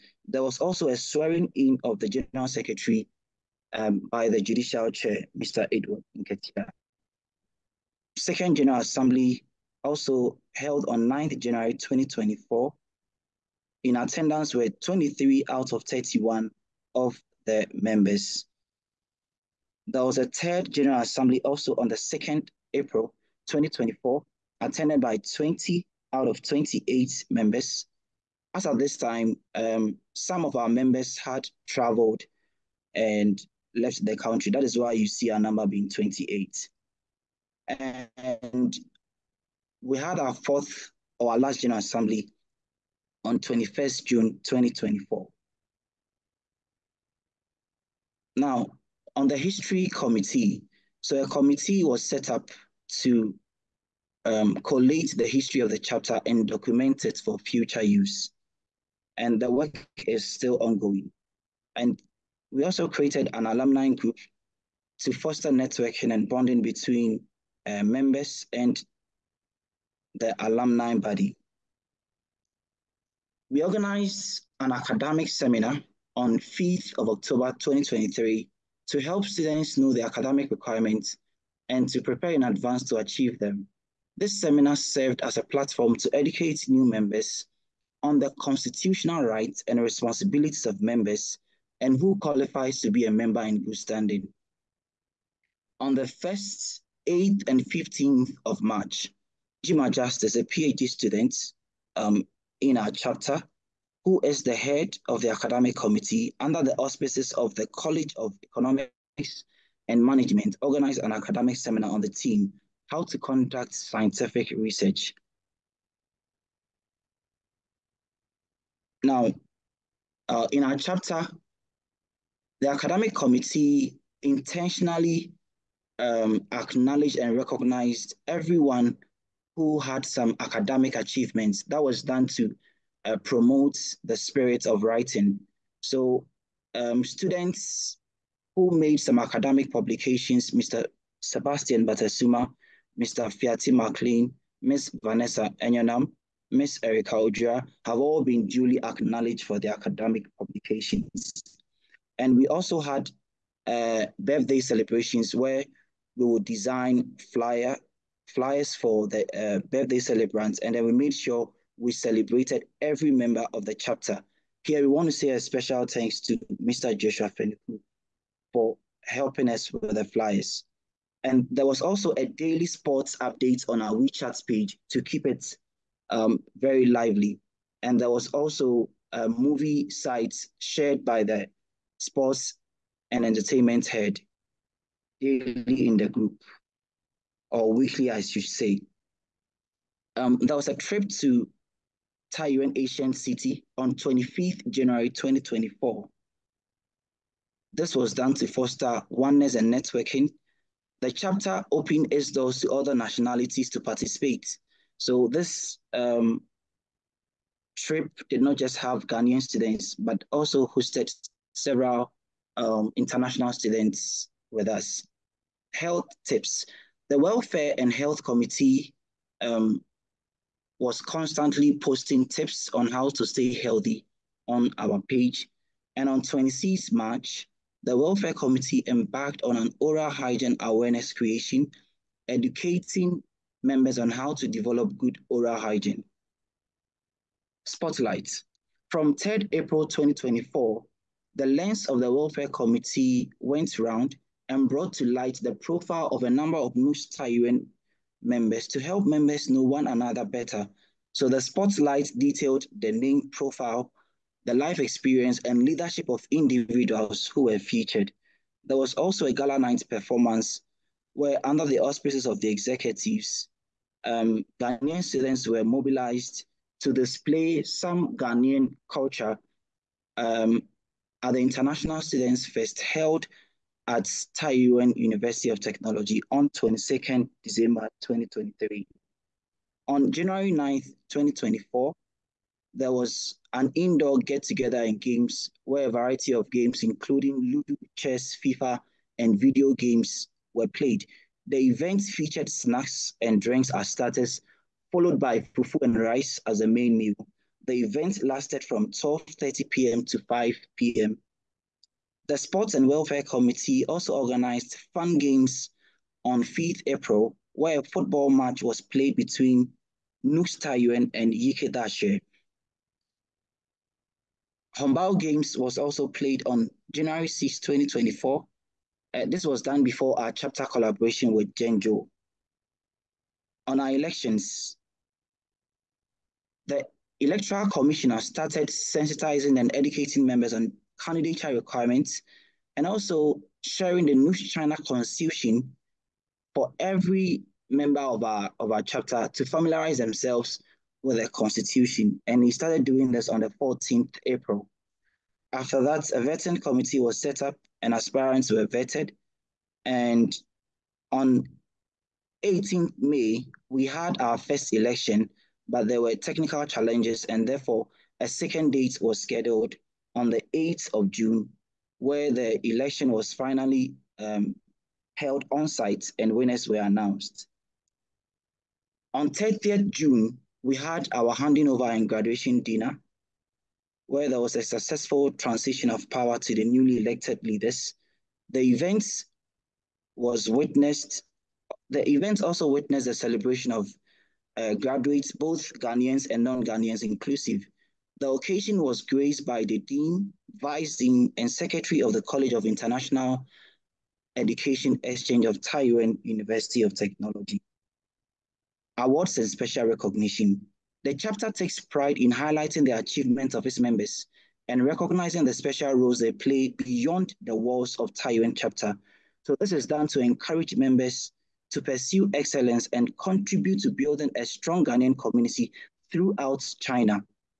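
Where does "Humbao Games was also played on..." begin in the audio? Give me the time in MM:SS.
05:14.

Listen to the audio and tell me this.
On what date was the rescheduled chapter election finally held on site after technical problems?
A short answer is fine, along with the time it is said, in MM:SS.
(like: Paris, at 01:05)
8 June, at 06:00.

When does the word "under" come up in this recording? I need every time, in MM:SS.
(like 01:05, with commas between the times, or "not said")
01:46, 04:21.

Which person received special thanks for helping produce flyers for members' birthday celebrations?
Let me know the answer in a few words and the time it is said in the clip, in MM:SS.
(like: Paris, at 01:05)
Joshua Fenuku, at 02:46.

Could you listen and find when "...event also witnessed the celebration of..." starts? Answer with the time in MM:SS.
06:22.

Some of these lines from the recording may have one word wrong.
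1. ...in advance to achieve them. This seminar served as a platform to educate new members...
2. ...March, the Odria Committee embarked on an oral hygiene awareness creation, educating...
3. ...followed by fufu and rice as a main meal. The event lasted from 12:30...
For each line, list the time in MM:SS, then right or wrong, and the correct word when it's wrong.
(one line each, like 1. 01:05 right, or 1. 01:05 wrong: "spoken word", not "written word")
1. 01:22 right
2. 03:46 wrong: "Welfare", not "Odria"
3. 04:54 right.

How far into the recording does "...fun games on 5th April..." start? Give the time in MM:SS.
05:04.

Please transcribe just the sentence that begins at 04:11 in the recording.
So the spotlight detailed the name profile the life experience and leadership of individuals who were featured.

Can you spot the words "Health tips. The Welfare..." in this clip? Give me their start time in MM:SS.
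03:35.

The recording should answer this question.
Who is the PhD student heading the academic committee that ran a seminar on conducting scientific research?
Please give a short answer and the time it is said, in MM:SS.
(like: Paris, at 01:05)
Jima Justice, at 01:39.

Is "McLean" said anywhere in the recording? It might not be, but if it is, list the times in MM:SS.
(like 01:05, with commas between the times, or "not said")
02:23.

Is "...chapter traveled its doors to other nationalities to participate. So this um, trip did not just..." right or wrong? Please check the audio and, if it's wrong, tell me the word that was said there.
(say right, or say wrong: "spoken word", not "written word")
wrong: "opened", not "traveled".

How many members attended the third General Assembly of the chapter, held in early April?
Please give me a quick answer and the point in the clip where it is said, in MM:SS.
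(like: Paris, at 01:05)
20, at 00:25.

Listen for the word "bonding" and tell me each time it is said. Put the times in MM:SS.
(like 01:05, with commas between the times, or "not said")
01:06.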